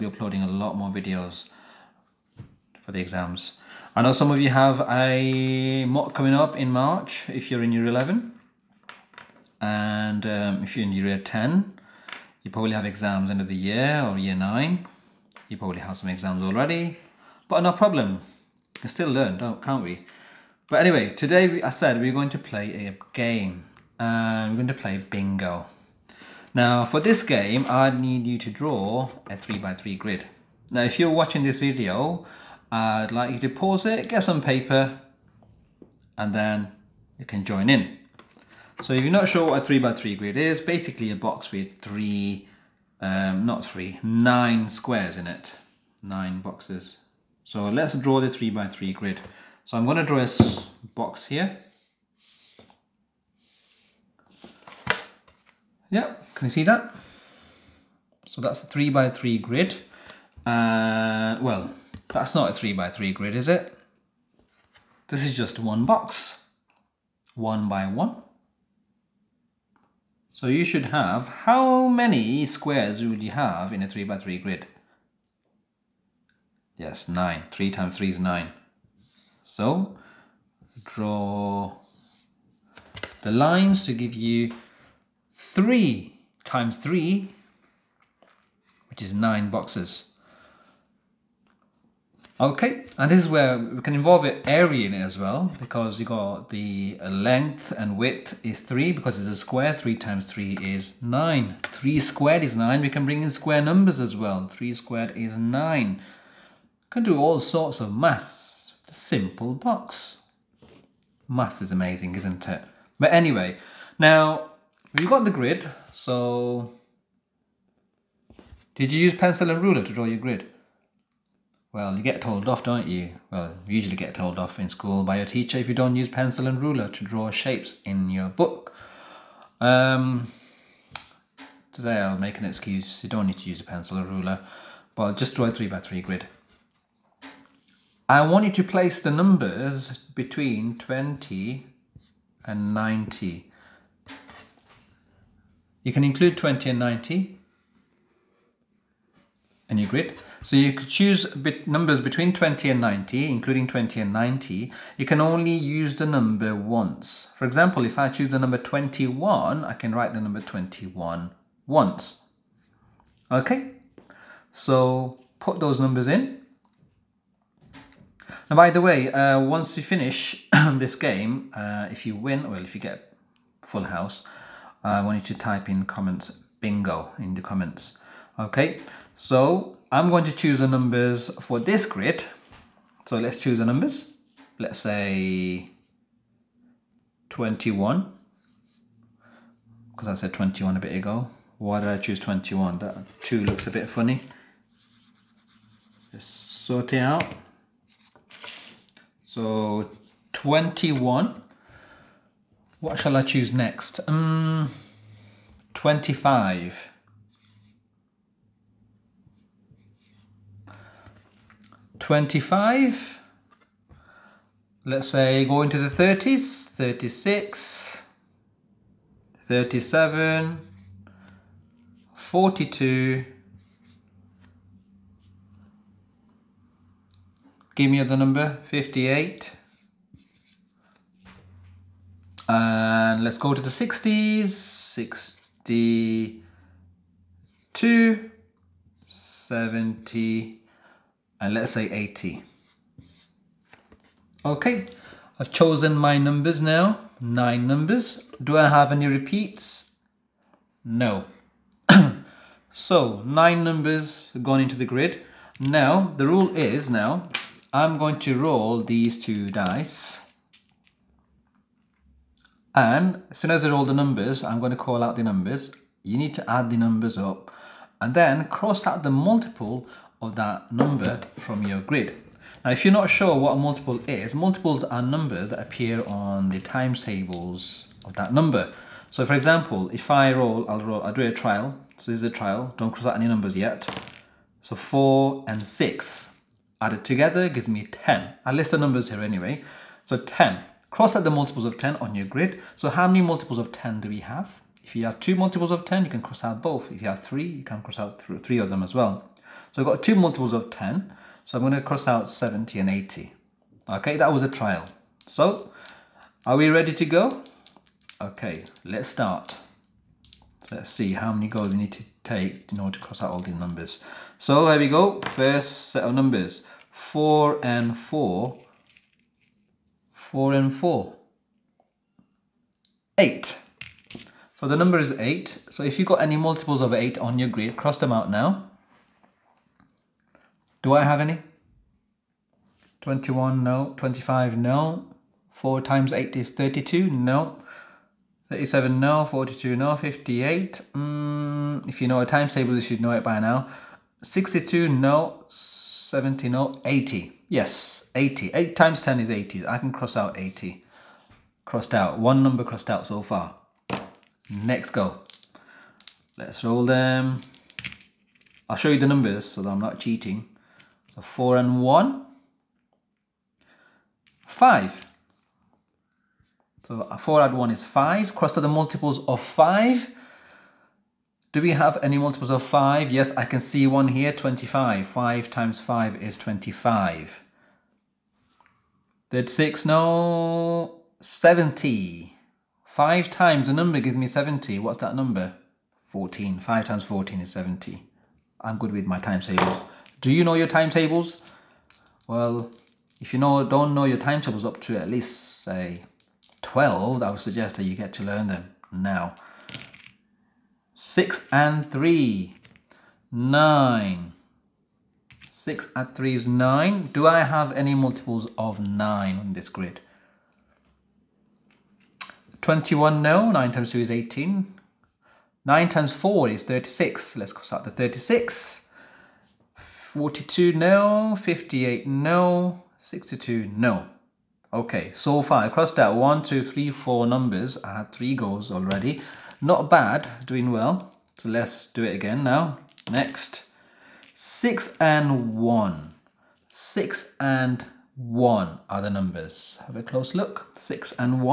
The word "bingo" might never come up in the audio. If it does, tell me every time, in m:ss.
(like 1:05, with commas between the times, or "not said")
0:24, 2:56.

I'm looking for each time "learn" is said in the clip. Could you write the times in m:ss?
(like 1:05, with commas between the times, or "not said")
0:19, 6:38.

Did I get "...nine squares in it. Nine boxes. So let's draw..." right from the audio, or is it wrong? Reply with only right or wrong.
right.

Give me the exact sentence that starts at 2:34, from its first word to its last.
You can only use the number once.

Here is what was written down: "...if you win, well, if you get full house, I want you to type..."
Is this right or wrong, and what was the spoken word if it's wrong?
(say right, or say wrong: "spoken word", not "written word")
right.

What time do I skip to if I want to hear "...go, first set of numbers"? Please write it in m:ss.
5:14.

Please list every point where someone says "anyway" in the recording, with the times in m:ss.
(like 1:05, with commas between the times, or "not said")
0:20, 1:53, 4:49.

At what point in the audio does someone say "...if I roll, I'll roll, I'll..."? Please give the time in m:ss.
4:39.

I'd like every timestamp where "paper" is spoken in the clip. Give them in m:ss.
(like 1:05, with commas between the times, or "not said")
0:34.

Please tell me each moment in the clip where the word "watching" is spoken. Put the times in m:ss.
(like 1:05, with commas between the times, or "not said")
0:31.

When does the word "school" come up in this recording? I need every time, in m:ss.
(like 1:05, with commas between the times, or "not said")
2:04.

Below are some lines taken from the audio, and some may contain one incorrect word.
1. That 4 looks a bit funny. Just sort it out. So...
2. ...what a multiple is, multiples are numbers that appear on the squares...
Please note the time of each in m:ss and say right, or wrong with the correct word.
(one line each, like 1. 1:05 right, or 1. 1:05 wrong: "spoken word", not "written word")
1. 3:12 wrong: "2", not "4"
2. 4:33 wrong: "times", not "squares".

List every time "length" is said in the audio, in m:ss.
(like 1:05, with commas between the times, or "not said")
1:37.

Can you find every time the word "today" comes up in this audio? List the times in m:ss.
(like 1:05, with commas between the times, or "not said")
0:21, 2:11.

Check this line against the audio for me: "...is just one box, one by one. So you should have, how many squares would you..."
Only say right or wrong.
right.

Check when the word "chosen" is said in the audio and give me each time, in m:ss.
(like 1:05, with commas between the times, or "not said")
4:05.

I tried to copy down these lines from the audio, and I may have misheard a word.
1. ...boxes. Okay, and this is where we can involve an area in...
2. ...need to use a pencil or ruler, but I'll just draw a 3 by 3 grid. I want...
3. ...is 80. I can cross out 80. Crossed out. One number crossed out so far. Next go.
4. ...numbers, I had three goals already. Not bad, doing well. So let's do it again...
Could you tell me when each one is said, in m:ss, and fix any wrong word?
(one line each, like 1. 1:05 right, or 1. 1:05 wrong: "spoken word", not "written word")
1. 1:29 right
2. 2:13 right
3. 5:49 right
4. 7:07 right.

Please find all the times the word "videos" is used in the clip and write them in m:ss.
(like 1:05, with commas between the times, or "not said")
0:00, 0:31.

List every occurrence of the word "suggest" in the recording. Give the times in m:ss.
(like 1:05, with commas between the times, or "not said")
6:37.